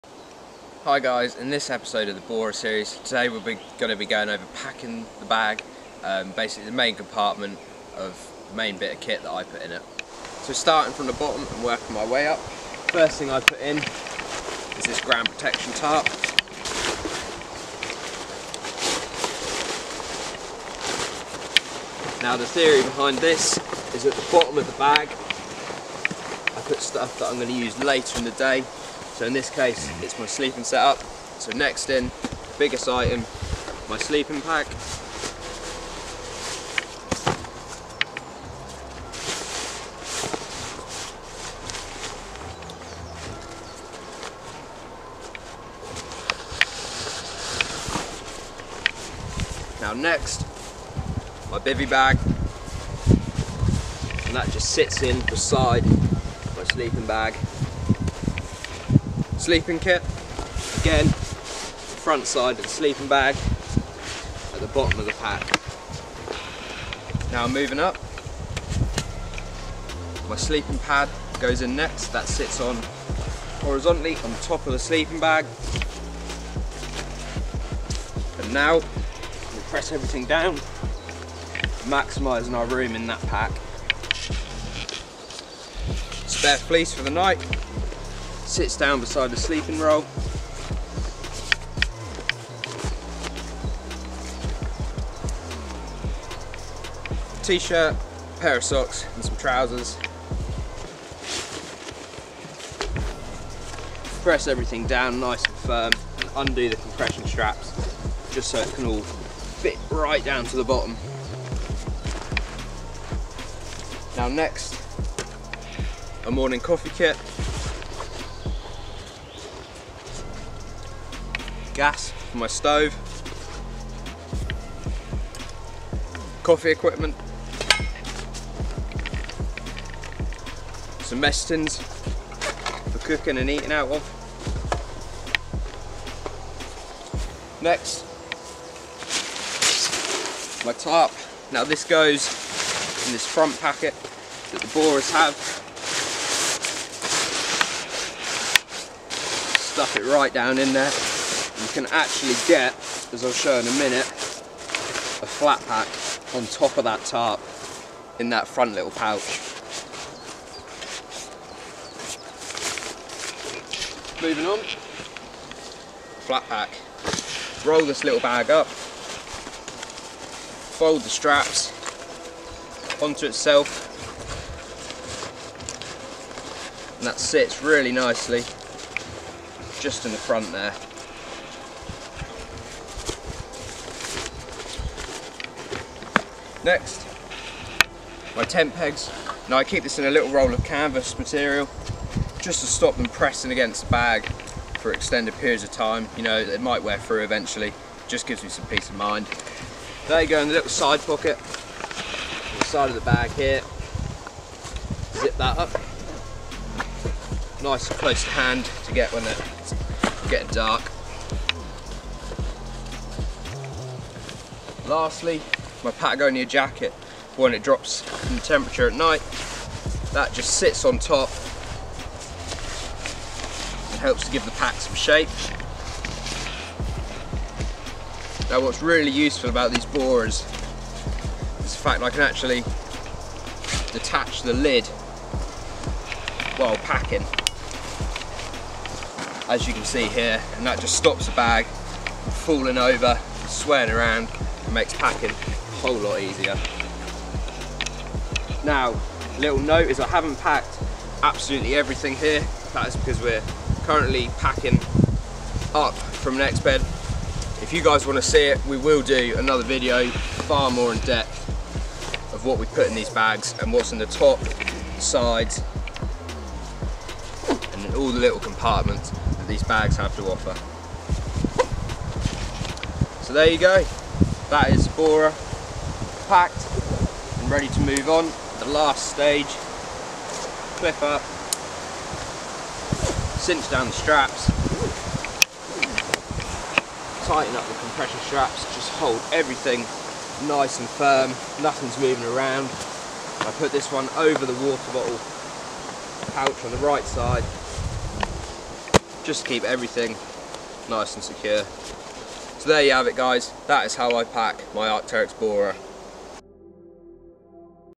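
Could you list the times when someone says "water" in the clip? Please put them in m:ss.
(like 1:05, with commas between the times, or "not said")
4:54.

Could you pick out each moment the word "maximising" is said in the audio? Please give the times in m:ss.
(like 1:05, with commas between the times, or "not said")
1:21.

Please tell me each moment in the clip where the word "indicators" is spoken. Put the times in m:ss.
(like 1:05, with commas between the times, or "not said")
not said.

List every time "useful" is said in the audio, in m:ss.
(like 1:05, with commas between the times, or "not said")
3:49.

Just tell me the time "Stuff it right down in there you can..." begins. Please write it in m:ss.
2:29.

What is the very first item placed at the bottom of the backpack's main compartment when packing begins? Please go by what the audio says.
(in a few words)
Ground protection tarp.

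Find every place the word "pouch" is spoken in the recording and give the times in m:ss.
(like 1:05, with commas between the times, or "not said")
2:38, 4:56.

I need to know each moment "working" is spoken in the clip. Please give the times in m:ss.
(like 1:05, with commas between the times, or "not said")
0:11.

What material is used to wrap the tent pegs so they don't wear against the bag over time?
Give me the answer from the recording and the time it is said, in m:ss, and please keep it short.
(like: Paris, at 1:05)
Canvas, at 3:10.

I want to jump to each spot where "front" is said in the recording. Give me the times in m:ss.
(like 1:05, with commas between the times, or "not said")
1:01, 2:23, 2:38, 3:00.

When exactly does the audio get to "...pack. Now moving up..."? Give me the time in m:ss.
1:05.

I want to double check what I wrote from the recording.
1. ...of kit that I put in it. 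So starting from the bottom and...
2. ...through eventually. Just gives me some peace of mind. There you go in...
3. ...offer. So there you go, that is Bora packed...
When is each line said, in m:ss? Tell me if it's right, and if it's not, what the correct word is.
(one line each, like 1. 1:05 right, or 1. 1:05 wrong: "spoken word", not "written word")
1. 0:08 right
2. 3:16 right
3. 4:30 right.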